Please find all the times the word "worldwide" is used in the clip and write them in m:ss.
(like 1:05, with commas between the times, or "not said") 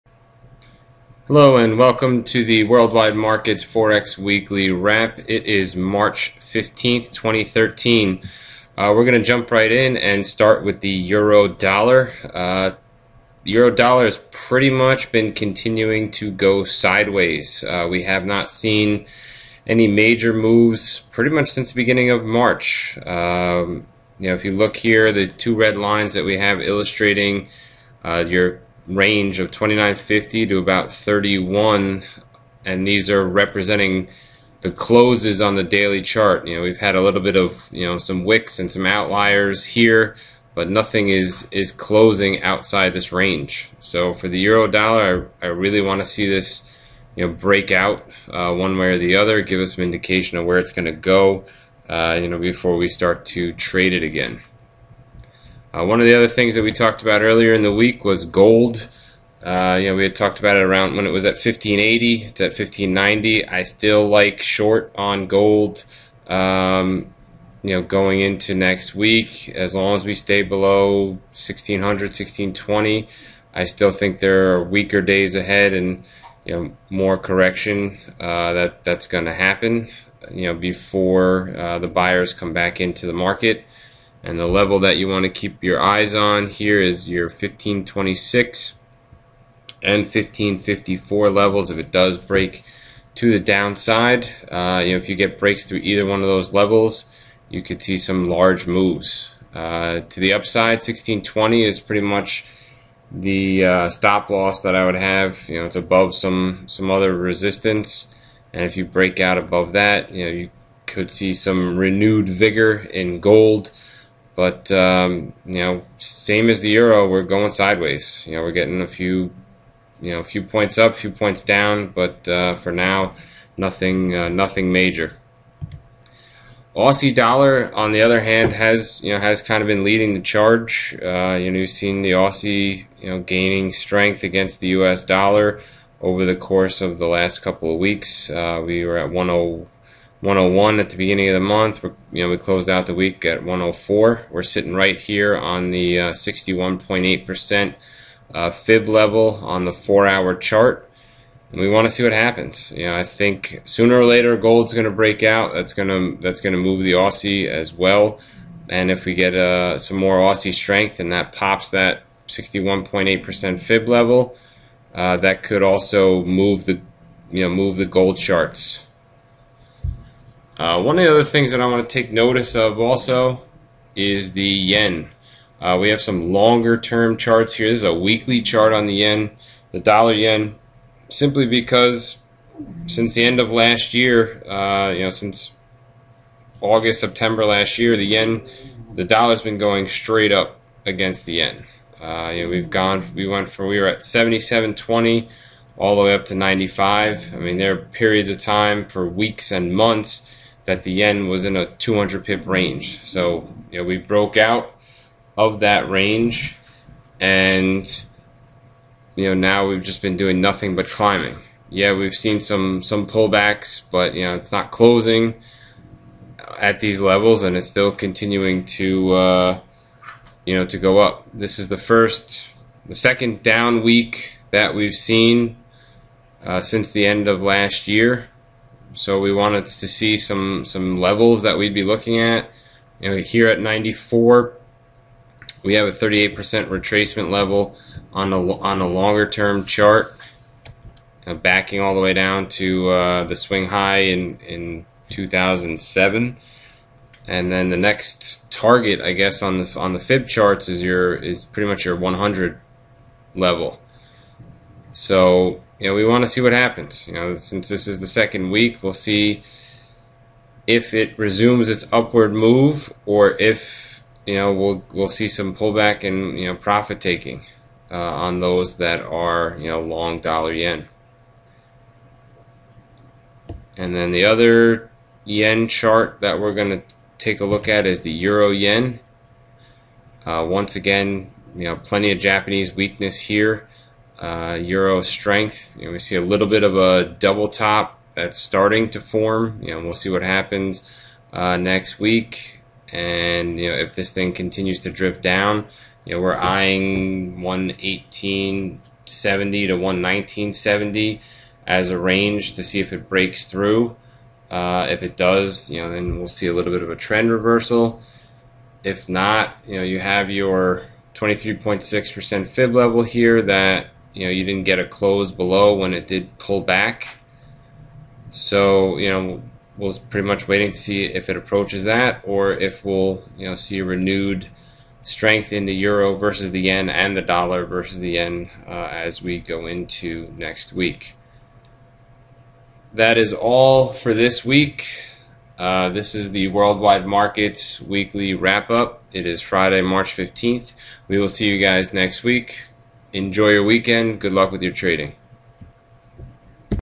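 0:02, 5:36.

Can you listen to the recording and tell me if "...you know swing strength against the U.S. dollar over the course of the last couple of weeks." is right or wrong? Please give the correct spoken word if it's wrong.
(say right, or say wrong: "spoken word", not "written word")
wrong: "gaining", not "swing".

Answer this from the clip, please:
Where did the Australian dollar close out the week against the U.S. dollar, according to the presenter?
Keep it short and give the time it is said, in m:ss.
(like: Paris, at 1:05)
104, at 2:22.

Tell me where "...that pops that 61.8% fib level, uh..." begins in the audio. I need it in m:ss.
2:41.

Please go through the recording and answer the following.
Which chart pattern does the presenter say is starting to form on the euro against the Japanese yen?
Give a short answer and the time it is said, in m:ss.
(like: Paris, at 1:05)
double top, at 4:47.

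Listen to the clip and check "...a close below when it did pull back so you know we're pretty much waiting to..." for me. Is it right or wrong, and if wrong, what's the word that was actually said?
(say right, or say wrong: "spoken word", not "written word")
right.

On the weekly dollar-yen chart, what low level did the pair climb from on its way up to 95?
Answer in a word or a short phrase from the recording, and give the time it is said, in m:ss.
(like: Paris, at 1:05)
77.20, at 3:14.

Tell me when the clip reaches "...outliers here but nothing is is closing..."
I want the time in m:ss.
0:38.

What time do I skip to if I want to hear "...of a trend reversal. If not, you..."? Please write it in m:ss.
5:06.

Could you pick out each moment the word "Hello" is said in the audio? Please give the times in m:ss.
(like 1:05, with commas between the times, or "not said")
0:01.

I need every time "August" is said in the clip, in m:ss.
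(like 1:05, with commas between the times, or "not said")
3:06.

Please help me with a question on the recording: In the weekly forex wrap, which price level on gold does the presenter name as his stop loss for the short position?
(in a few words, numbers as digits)
1620.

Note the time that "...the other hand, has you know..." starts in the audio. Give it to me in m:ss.
2:07.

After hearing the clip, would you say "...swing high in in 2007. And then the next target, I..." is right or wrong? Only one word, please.
right.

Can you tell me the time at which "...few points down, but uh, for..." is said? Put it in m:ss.
2:00.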